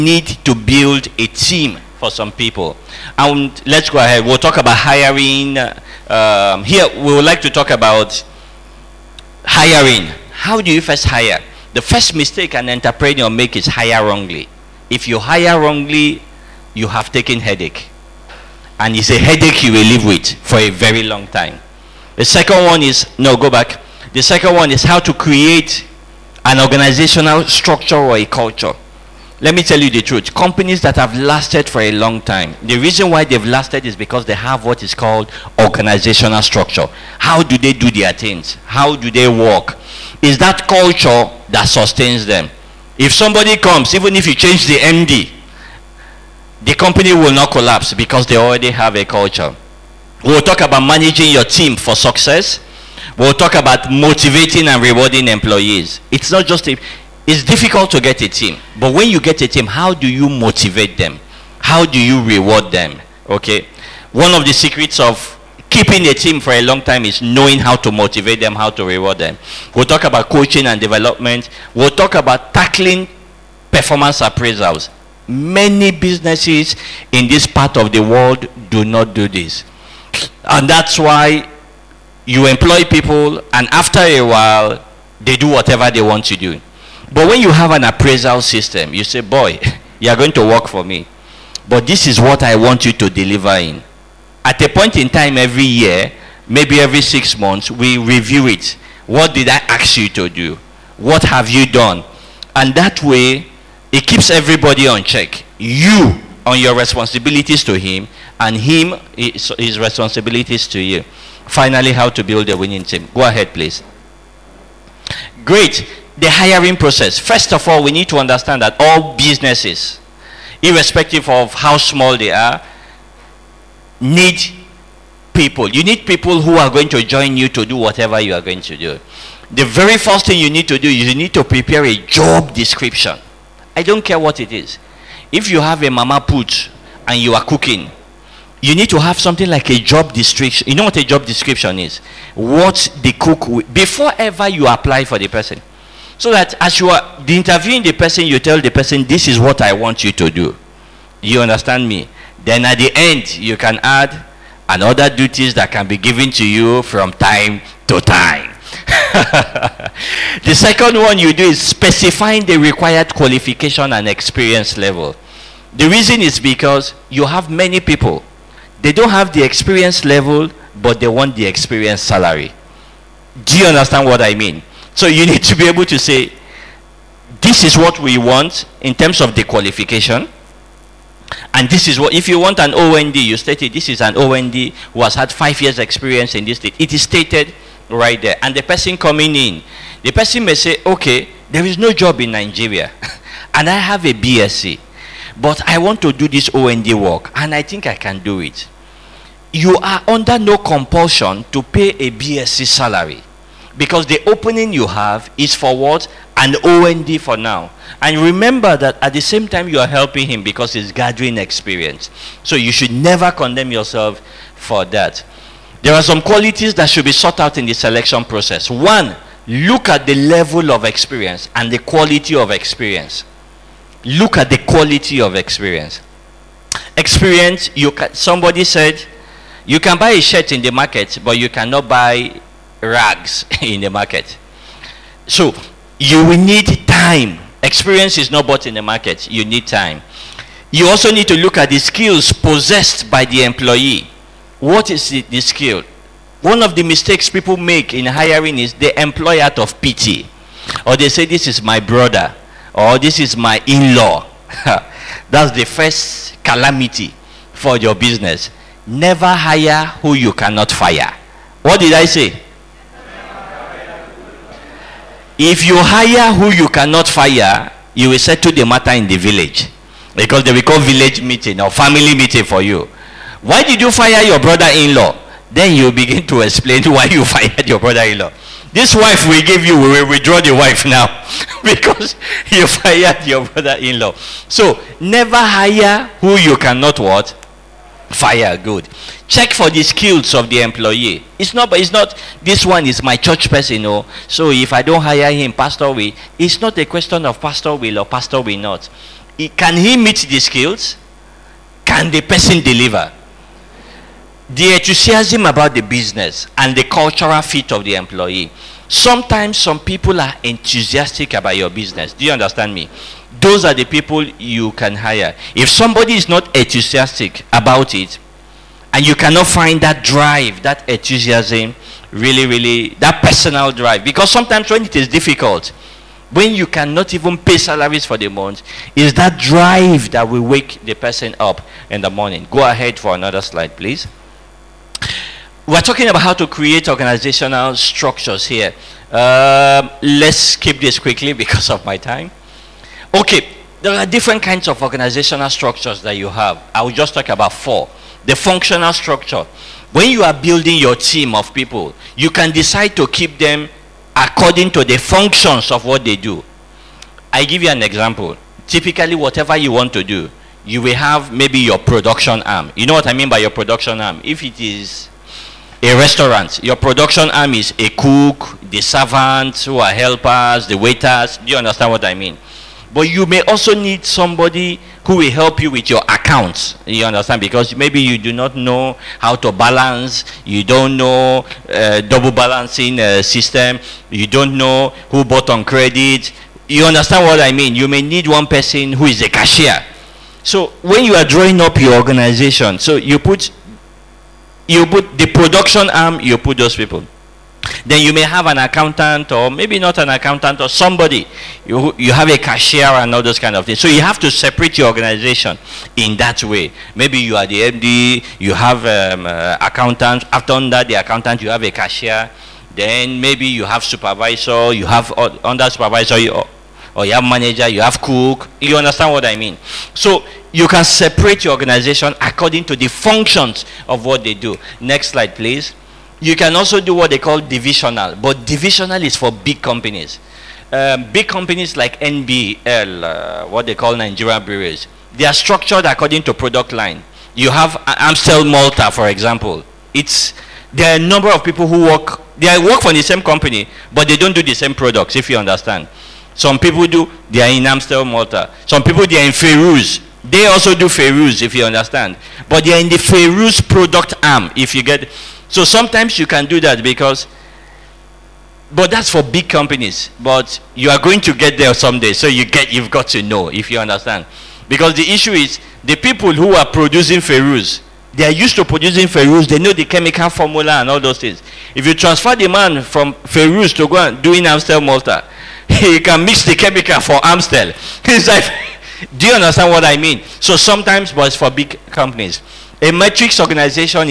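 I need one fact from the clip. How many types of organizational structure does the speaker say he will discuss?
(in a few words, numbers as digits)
4.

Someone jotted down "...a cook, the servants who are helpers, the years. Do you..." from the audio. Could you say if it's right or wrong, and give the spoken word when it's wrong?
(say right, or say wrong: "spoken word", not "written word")
wrong: "waiters", not "years".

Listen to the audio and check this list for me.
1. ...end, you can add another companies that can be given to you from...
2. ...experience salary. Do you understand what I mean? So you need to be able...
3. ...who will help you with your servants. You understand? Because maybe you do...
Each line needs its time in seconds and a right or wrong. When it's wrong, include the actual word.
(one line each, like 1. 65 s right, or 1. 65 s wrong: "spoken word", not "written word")
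1. 152 s wrong: "duties", not "companies"
2. 171 s right
3. 375 s wrong: "accounts", not "servants".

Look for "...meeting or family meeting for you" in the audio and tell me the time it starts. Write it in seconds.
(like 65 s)
271 s.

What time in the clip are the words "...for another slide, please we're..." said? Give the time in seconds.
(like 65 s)
332 s.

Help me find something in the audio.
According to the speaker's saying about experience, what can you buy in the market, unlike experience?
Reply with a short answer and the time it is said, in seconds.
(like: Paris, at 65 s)
a shirt, at 230 s.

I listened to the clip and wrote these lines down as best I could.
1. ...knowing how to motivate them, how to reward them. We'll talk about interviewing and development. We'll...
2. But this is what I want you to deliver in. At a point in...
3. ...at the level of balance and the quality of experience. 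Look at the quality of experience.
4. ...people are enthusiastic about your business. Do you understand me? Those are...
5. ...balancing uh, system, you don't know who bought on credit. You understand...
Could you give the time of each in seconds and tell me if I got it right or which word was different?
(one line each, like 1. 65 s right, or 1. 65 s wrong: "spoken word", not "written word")
1. 67 s wrong: "coaching", not "interviewing"
2. 91 s right
3. 219 s wrong: "experience", not "balance"
4. 309 s right
5. 382 s right.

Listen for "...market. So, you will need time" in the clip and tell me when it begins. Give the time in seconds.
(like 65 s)
233 s.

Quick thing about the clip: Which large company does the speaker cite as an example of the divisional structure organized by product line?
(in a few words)
Nigeria breweries.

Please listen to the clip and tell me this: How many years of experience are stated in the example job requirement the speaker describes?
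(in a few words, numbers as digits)
5.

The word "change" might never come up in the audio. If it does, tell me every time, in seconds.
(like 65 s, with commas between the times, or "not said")
44 s.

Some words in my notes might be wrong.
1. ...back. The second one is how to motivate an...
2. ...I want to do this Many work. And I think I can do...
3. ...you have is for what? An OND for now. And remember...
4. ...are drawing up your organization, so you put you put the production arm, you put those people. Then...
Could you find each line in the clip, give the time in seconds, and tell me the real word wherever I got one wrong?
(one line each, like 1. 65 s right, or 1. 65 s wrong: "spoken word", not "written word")
1. 23 s wrong: "create", not "motivate"
2. 195 s wrong: "OND", not "Many"
3. 204 s right
4. 391 s right.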